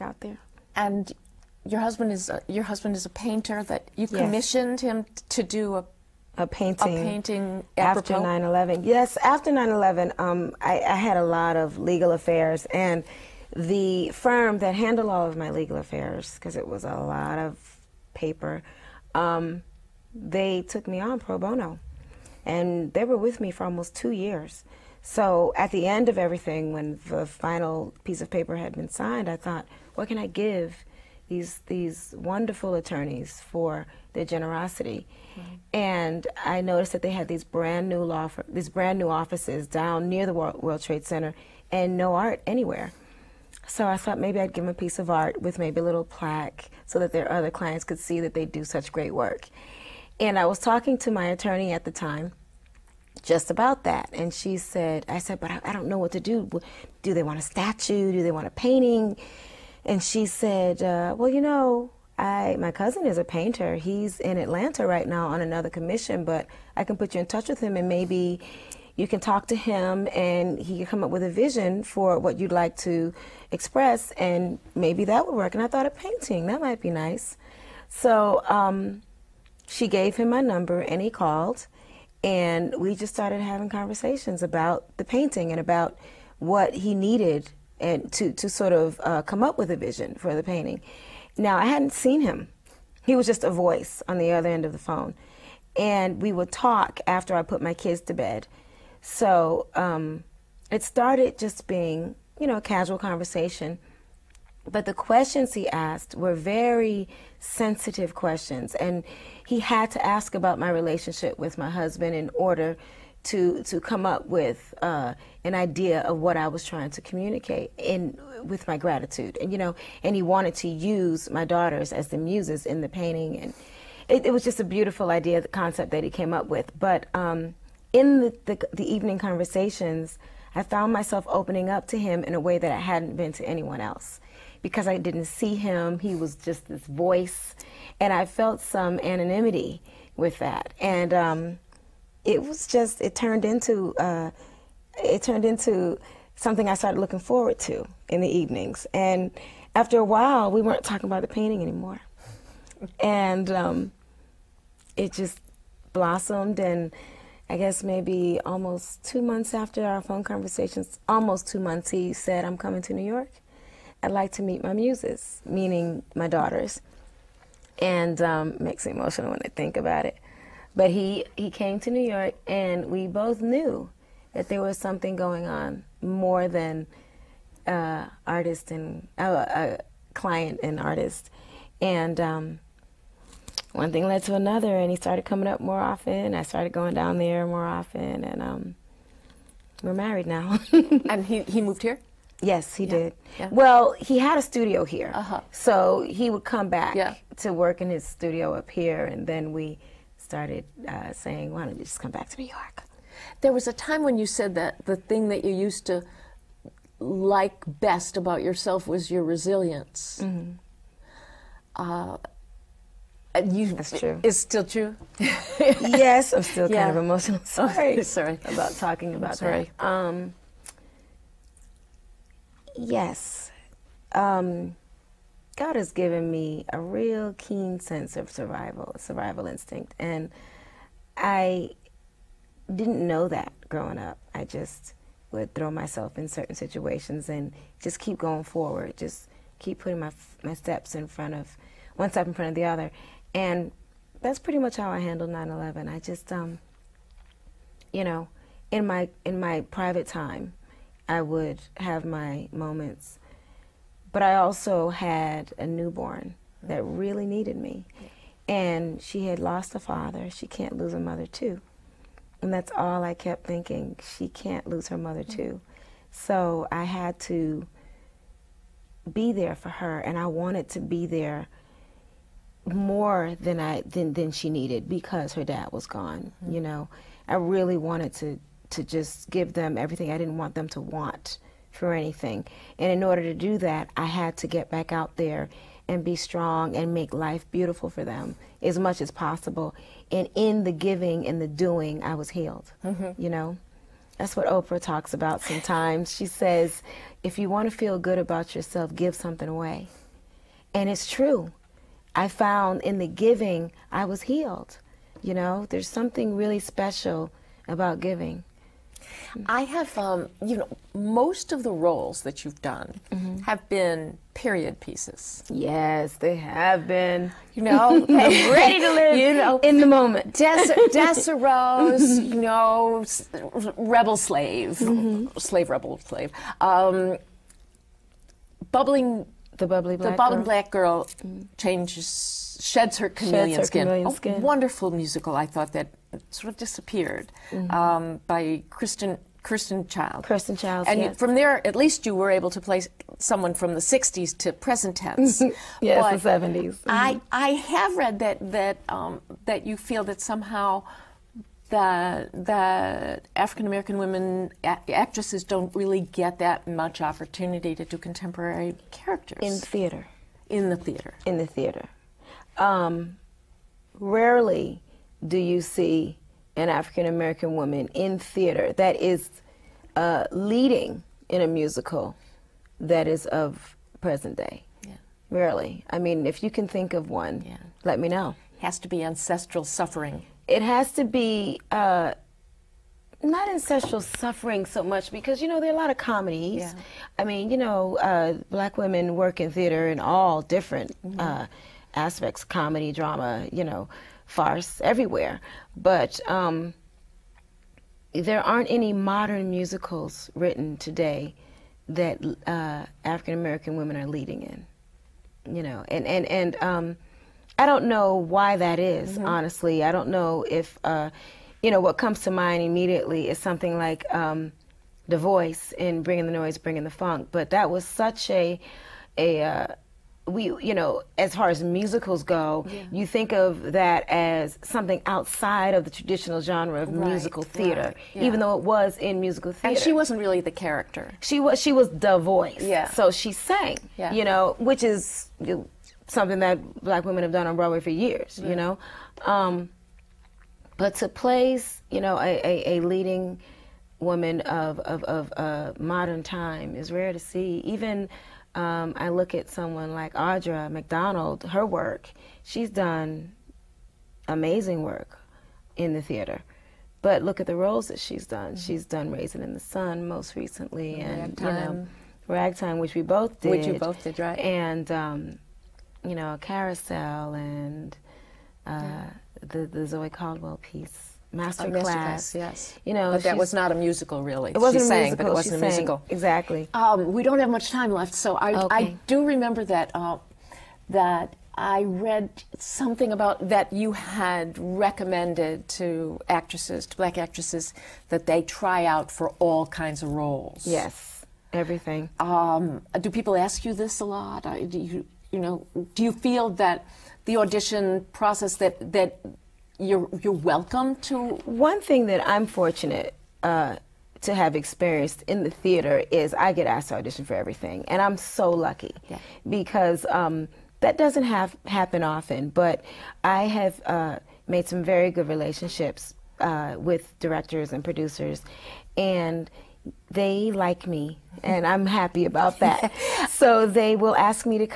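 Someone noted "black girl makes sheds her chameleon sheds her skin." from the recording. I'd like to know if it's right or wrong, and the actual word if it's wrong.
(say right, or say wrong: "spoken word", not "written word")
wrong: "changes", not "makes".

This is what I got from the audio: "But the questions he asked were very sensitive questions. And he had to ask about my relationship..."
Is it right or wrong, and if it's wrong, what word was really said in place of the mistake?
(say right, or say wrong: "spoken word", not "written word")
right.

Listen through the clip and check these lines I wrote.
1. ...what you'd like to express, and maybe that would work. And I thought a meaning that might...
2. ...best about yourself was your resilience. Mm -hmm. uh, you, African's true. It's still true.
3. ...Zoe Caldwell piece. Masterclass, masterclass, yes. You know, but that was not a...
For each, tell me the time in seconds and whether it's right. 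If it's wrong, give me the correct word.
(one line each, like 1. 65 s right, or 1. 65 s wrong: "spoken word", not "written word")
1. 72 s wrong: "painting", not "meaning"
2. 207 s wrong: "That", not "African"
3. 469 s right.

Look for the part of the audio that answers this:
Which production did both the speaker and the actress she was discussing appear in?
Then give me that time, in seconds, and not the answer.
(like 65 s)
462 s.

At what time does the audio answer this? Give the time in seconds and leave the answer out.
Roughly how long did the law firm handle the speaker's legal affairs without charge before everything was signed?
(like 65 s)
23 s.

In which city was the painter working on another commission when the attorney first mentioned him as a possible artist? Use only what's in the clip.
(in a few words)
Atlanta.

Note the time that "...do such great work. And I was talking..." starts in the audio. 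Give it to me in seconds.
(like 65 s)
48 s.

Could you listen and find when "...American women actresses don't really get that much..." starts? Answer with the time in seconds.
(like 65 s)
353 s.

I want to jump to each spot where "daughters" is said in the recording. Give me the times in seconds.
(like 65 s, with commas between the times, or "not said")
121 s, 166 s.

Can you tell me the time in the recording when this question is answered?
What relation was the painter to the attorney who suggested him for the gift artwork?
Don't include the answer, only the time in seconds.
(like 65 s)
62 s.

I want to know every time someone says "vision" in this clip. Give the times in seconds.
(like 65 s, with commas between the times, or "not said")
71 s, 89 s.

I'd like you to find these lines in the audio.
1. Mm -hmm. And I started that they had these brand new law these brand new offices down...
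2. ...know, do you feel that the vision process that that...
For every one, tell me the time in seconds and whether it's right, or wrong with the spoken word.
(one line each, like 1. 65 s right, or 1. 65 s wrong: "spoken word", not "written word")
1. 35 s wrong: "noticed", not "started"
2. 495 s wrong: "audition", not "vision".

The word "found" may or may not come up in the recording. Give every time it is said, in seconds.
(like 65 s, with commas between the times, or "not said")
130 s, 302 s.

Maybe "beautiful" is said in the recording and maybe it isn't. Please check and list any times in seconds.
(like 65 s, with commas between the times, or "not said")
124 s, 287 s.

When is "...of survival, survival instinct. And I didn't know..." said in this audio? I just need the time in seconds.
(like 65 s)
228 s.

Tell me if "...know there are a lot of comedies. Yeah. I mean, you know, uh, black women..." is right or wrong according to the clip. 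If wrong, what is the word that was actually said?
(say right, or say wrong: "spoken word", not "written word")
right.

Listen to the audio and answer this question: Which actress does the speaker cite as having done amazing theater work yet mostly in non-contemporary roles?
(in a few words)
Audra McDonald.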